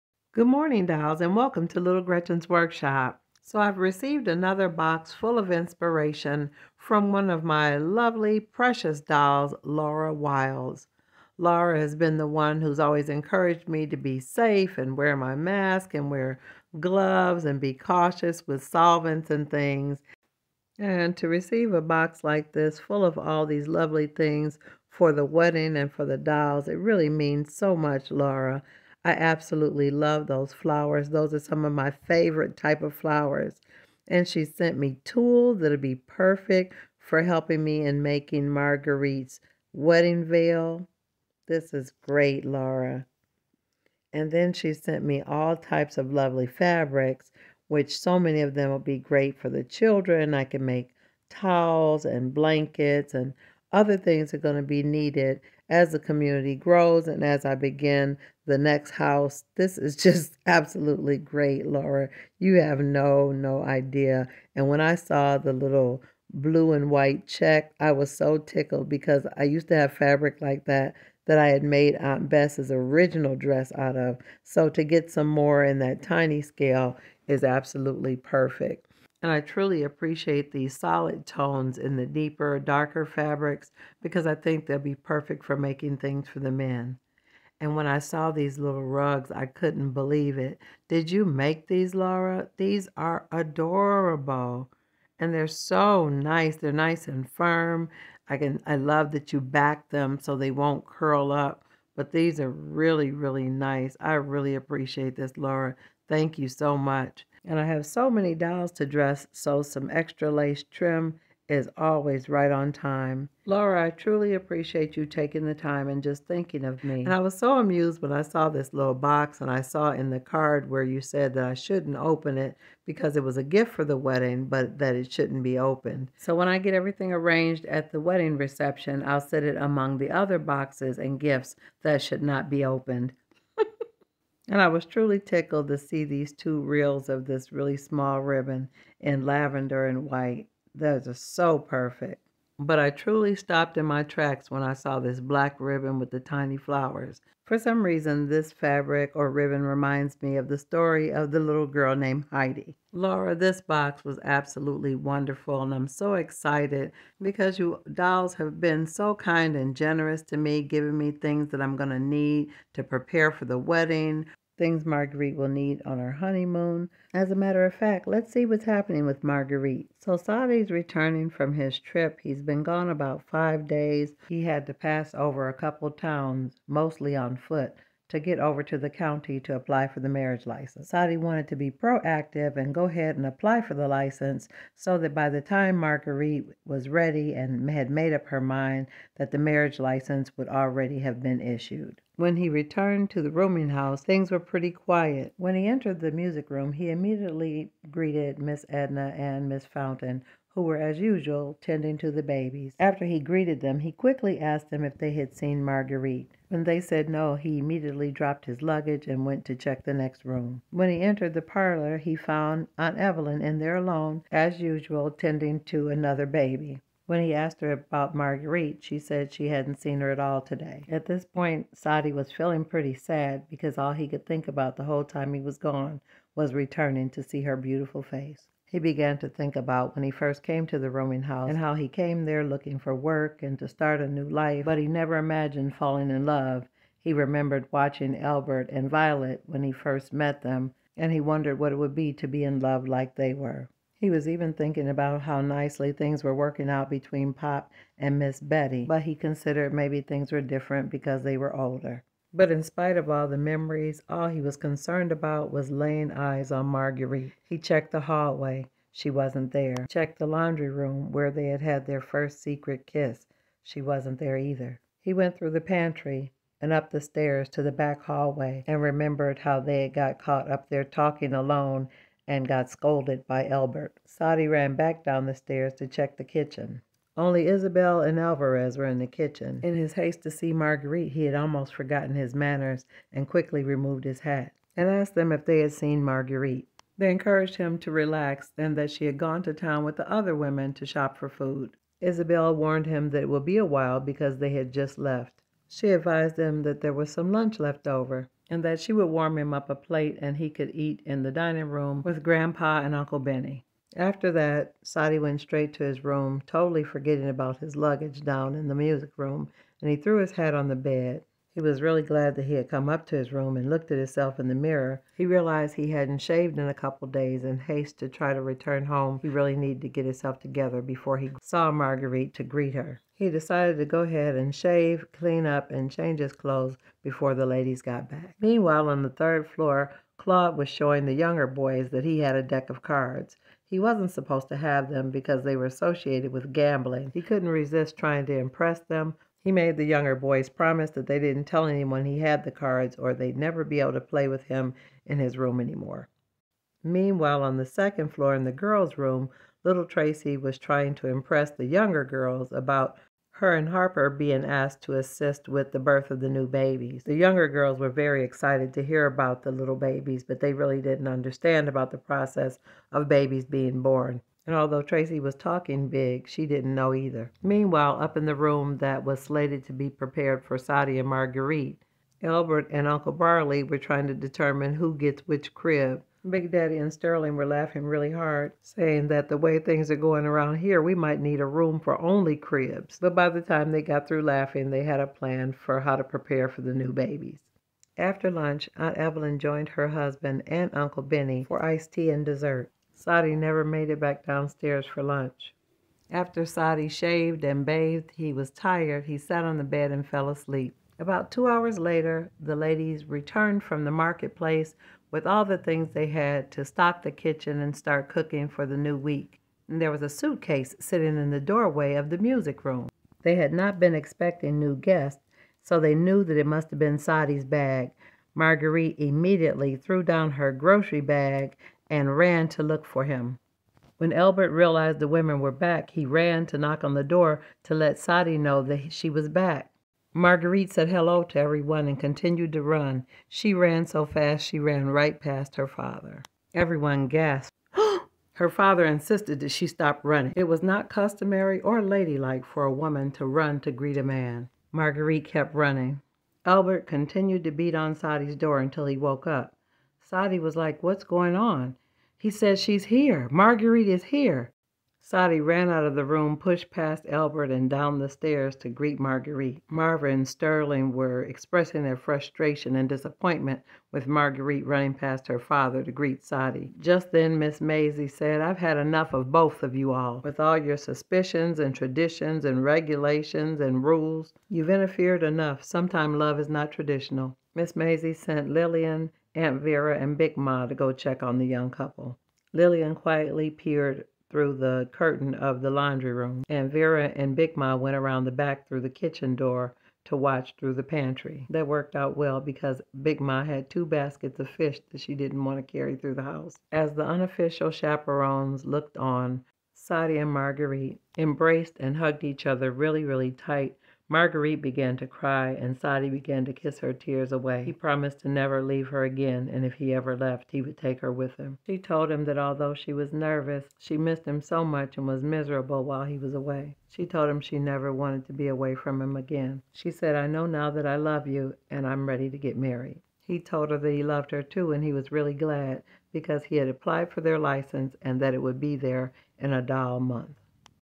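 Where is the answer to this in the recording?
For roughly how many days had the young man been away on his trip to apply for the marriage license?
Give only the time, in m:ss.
2:53.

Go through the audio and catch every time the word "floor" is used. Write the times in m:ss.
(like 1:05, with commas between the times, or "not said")
5:29, 5:48.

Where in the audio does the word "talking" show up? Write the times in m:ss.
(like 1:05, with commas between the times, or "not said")
4:30, 6:05.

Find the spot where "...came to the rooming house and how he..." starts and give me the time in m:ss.
3:50.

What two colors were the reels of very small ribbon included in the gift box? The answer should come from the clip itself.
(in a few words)
Lavender and white.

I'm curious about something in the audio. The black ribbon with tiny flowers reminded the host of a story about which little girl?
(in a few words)
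Heidi.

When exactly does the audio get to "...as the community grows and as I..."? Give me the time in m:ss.
0:55.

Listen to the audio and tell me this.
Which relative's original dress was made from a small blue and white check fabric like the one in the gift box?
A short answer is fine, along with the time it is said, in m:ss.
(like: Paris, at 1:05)
Aunt Bess, at 1:11.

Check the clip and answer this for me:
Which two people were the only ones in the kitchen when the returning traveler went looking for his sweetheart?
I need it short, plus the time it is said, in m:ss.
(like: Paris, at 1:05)
Isabel and Alvarez, at 4:37.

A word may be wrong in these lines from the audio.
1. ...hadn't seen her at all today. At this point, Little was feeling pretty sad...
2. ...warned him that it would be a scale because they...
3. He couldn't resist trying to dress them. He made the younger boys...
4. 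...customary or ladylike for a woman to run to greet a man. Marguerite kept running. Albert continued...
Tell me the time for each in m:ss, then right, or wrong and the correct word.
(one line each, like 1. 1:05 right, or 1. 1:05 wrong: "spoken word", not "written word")
1. 3:39 wrong: "Saidi", not "Little"
2. 4:52 wrong: "while", not "scale"
3. 5:37 wrong: "impress", not "dress"
4. 7:20 right.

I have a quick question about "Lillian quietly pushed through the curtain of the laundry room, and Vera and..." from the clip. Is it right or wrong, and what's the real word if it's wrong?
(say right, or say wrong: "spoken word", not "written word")
wrong: "peered", not "pushed".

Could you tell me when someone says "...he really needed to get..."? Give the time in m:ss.
5:19.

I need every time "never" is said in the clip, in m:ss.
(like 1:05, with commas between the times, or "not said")
3:54, 5:43, 6:33, 8:28, 8:37.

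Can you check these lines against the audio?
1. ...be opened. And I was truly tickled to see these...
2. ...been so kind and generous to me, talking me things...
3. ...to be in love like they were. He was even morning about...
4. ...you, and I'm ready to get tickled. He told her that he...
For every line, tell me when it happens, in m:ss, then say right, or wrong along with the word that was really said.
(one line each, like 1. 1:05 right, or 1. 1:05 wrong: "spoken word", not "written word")
1. 2:12 right
2. 2:38 wrong: "giving", not "talking"
3. 4:02 wrong: "thinking", not "morning"
4. 8:41 wrong: "married", not "tickled".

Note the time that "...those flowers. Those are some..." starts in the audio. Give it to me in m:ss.
0:30.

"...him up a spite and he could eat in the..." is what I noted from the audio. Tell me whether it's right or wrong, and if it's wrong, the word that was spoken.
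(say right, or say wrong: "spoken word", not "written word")
wrong: "plate", not "spite".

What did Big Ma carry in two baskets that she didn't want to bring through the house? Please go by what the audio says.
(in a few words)
Fish.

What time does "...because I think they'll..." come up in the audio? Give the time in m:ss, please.
1:24.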